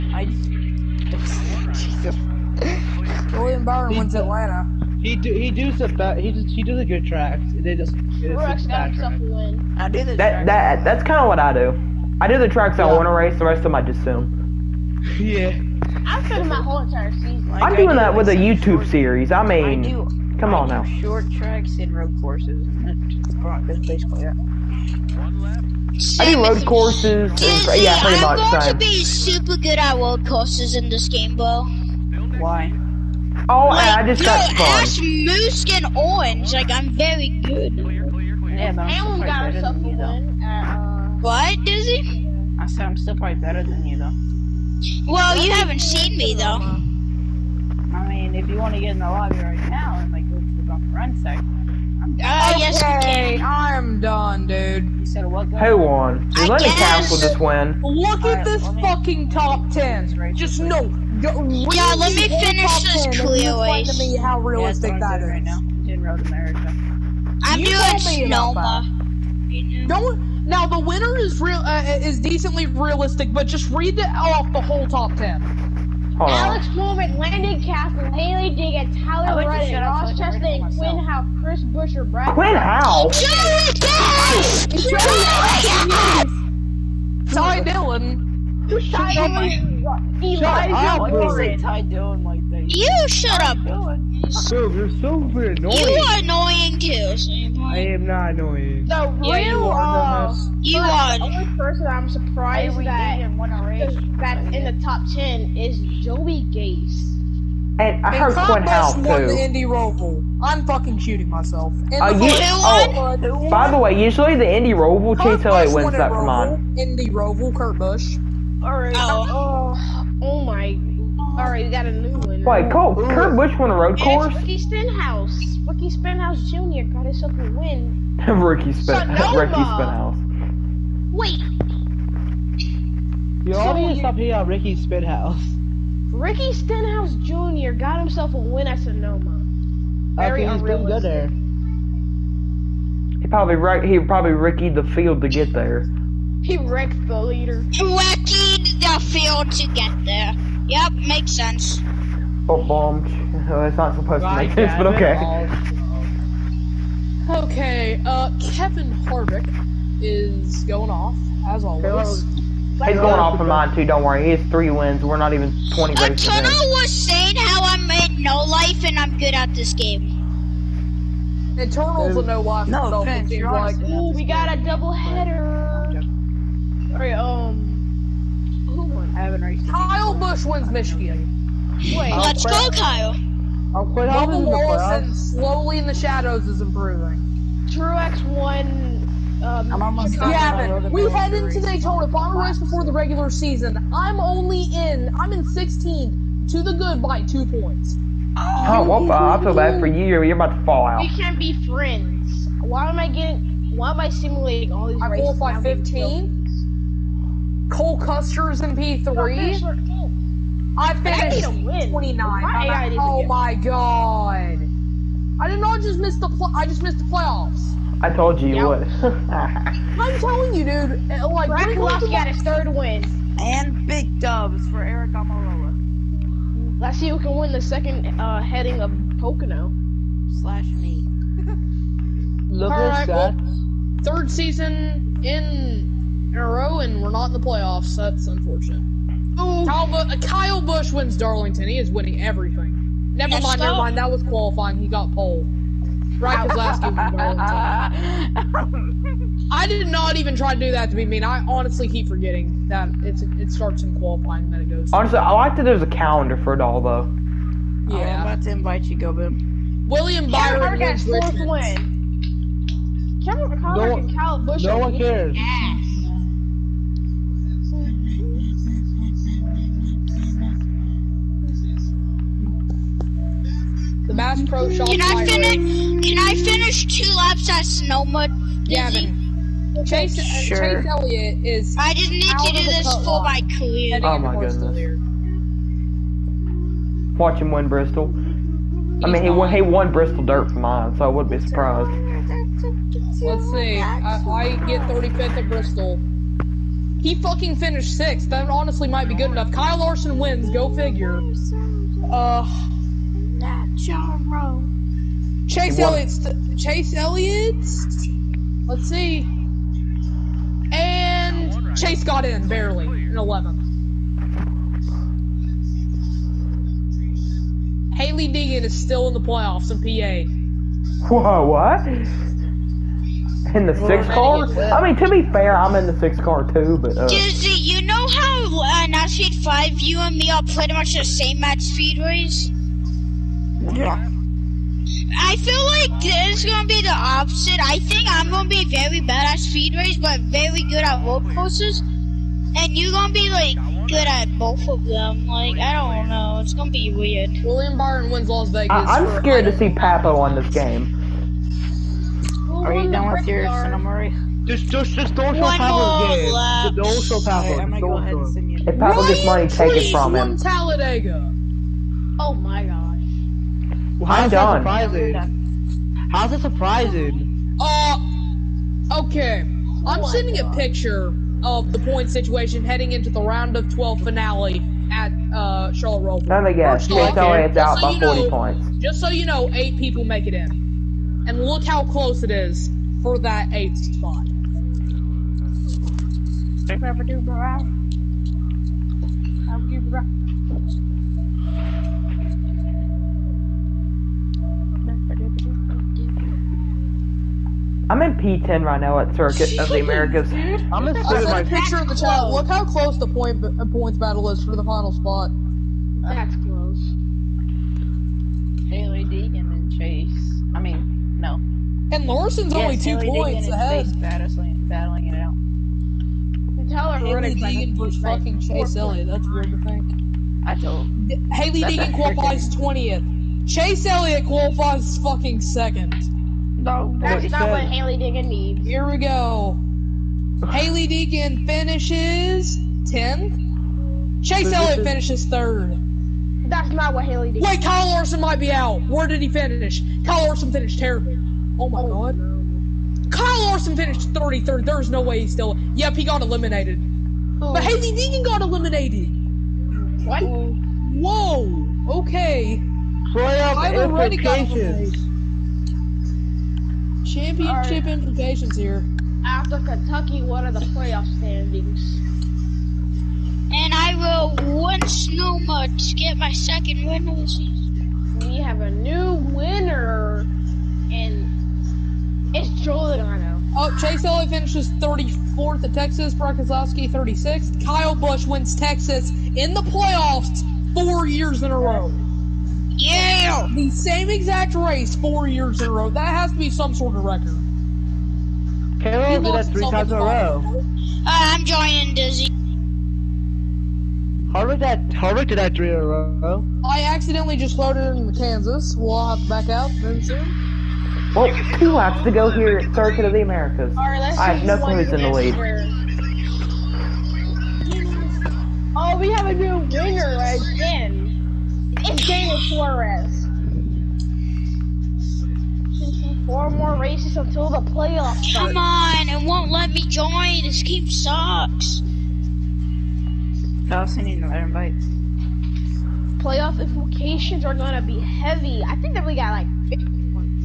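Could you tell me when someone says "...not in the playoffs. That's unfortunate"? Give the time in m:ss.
3:57.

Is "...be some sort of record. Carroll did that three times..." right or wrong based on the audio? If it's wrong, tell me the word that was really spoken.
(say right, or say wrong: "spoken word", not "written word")
right.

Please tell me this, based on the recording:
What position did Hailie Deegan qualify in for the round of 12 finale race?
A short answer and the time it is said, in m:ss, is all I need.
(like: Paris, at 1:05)
20th, at 7:01.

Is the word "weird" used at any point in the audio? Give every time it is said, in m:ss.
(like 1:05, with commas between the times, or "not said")
5:46, 6:59.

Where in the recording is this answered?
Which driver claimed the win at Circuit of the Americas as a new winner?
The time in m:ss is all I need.
8:31.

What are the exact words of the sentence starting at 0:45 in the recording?
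Well, you haven't seen me though.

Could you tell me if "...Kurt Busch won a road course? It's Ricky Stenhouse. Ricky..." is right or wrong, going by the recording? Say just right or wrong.
right.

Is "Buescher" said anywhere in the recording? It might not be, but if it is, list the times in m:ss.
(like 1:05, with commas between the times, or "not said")
1:21.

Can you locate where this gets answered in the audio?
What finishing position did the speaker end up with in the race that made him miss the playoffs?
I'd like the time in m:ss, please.
3:30.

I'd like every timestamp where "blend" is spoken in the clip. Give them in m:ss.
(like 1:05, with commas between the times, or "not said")
not said.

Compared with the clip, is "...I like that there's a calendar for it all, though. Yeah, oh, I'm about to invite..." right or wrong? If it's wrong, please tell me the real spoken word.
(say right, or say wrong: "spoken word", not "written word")
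right.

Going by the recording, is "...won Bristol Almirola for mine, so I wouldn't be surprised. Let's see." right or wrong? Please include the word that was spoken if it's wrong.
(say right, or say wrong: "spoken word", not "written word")
wrong: "Dirt", not "Almirola".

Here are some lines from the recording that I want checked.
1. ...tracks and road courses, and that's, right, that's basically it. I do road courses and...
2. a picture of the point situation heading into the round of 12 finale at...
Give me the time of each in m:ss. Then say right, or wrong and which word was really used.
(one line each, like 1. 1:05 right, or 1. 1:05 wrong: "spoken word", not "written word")
1. 0:21 right
2. 6:10 right.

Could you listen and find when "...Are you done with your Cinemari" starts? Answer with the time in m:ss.
5:52.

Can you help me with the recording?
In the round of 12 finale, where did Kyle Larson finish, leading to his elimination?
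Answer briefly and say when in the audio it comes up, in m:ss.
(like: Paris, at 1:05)
33rd, at 7:23.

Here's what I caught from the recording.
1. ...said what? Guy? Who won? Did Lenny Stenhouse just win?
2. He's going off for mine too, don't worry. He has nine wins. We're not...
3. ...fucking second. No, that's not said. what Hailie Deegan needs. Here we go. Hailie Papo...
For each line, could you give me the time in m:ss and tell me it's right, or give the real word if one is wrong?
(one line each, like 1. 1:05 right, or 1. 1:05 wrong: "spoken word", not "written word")
1. 0:55 wrong: "Cassill", not "Stenhouse"
2. 2:42 wrong: "three", not "nine"
3. 7:04 wrong: "Deegan", not "Papo".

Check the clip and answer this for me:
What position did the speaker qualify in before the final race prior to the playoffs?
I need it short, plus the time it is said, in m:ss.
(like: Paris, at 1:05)
15, at 3:25.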